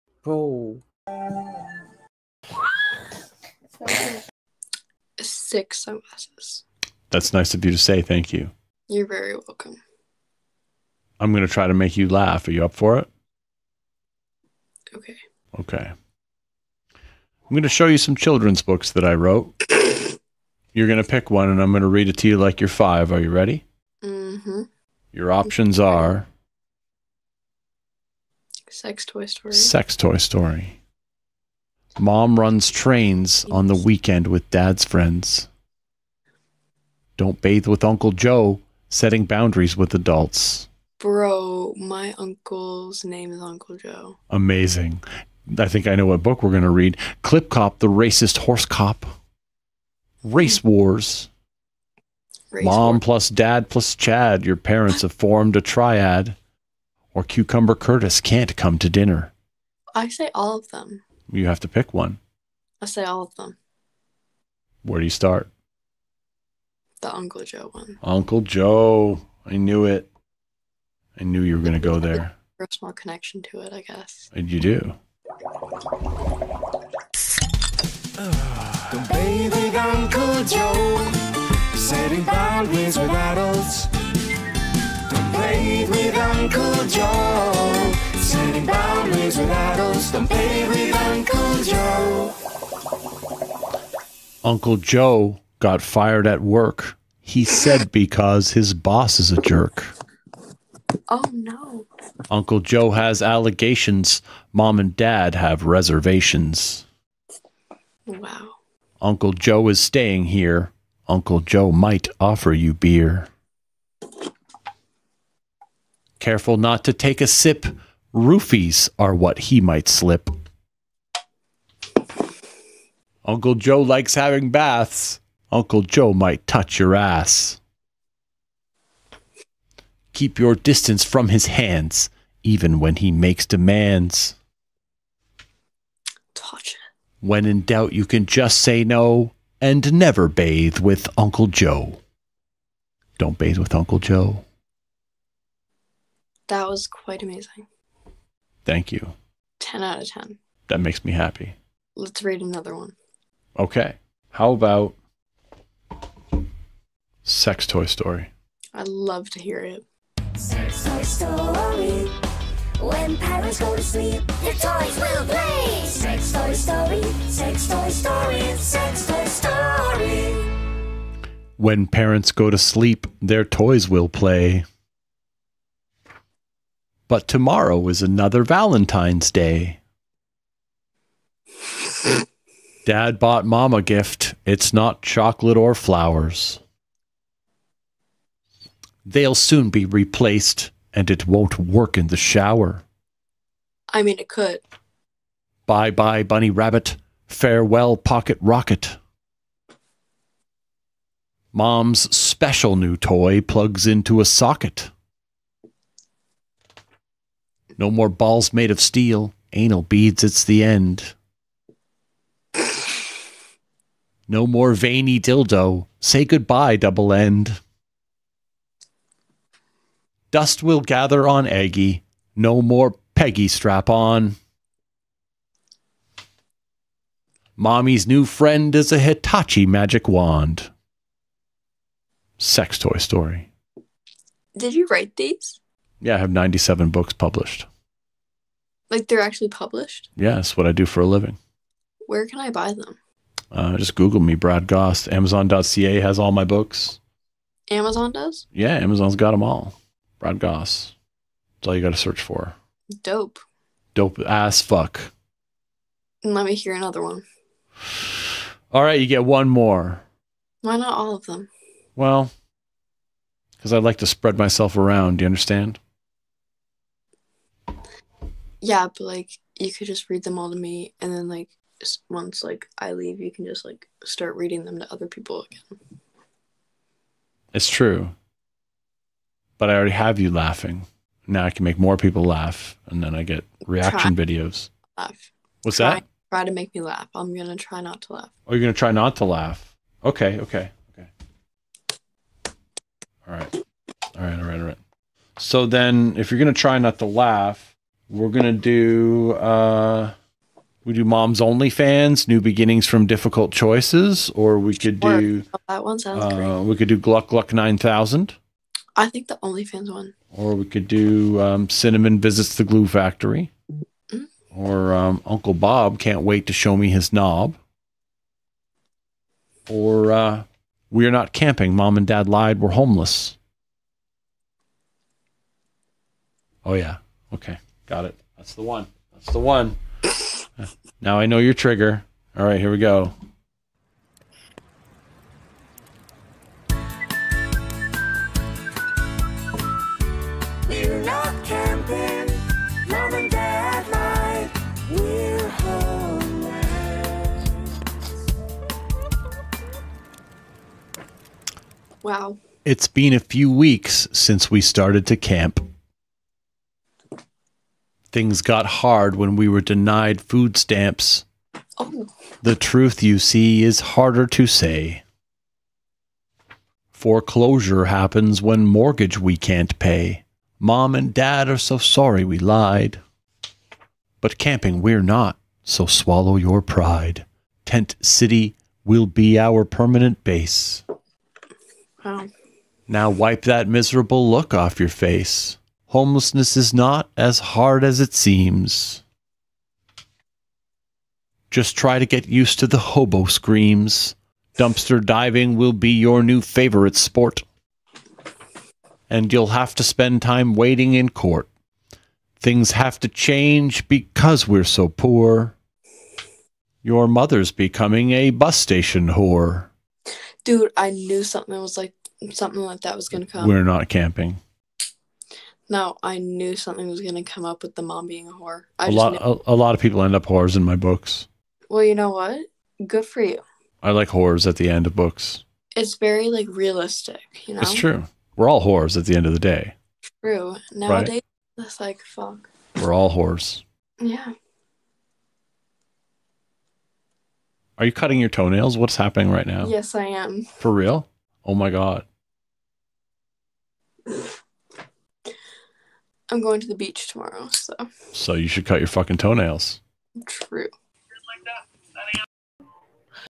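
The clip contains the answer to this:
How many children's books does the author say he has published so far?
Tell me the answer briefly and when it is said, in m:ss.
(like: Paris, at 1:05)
97, at 3:56.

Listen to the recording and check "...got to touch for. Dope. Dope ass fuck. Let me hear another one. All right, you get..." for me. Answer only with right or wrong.
wrong.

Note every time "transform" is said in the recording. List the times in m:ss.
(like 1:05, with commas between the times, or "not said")
not said.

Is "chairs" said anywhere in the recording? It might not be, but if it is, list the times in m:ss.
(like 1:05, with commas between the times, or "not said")
not said.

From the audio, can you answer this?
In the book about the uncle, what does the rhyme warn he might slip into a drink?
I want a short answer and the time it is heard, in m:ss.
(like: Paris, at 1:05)
Roofies, at 1:58.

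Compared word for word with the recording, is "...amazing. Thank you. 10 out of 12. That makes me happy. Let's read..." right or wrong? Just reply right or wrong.
wrong.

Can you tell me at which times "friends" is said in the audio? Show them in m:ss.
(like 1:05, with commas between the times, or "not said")
0:34, 3:48.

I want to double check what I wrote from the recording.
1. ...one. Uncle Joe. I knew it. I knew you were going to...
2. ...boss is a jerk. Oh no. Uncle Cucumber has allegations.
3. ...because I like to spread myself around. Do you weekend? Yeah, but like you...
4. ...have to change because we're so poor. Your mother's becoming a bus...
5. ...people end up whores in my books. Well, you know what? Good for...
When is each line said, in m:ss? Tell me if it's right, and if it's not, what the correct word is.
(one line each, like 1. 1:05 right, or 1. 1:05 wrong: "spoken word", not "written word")
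1. 1:07 right
2. 1:38 wrong: "Joe", not "Cucumber"
3. 4:23 wrong: "understand", not "weekend"
4. 6:42 right
5. 6:59 right.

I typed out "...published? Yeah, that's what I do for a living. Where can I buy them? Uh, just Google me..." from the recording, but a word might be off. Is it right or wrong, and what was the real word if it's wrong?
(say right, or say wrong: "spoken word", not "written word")
right.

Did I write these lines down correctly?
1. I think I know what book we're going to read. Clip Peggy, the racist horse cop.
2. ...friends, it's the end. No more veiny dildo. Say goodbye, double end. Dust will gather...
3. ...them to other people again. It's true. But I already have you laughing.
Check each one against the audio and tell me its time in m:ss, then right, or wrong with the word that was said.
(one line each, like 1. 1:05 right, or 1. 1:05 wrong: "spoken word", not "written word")
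1. 0:45 wrong: "Cop", not "Peggy"
2. 3:29 wrong: "beads", not "friends"
3. 4:34 right.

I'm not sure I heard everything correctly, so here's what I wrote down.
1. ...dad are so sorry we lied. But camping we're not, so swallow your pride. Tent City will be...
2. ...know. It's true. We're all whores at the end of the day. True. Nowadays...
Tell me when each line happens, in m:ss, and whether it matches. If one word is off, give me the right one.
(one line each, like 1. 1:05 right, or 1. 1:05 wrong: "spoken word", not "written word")
1. 6:11 right
2. 7:07 right.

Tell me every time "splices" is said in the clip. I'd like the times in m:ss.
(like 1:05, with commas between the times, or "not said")
not said.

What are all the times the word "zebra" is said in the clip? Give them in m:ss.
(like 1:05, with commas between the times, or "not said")
not said.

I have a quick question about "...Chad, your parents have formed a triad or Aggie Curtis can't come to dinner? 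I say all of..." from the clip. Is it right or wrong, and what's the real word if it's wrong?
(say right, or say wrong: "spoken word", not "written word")
wrong: "Cucumber", not "Aggie".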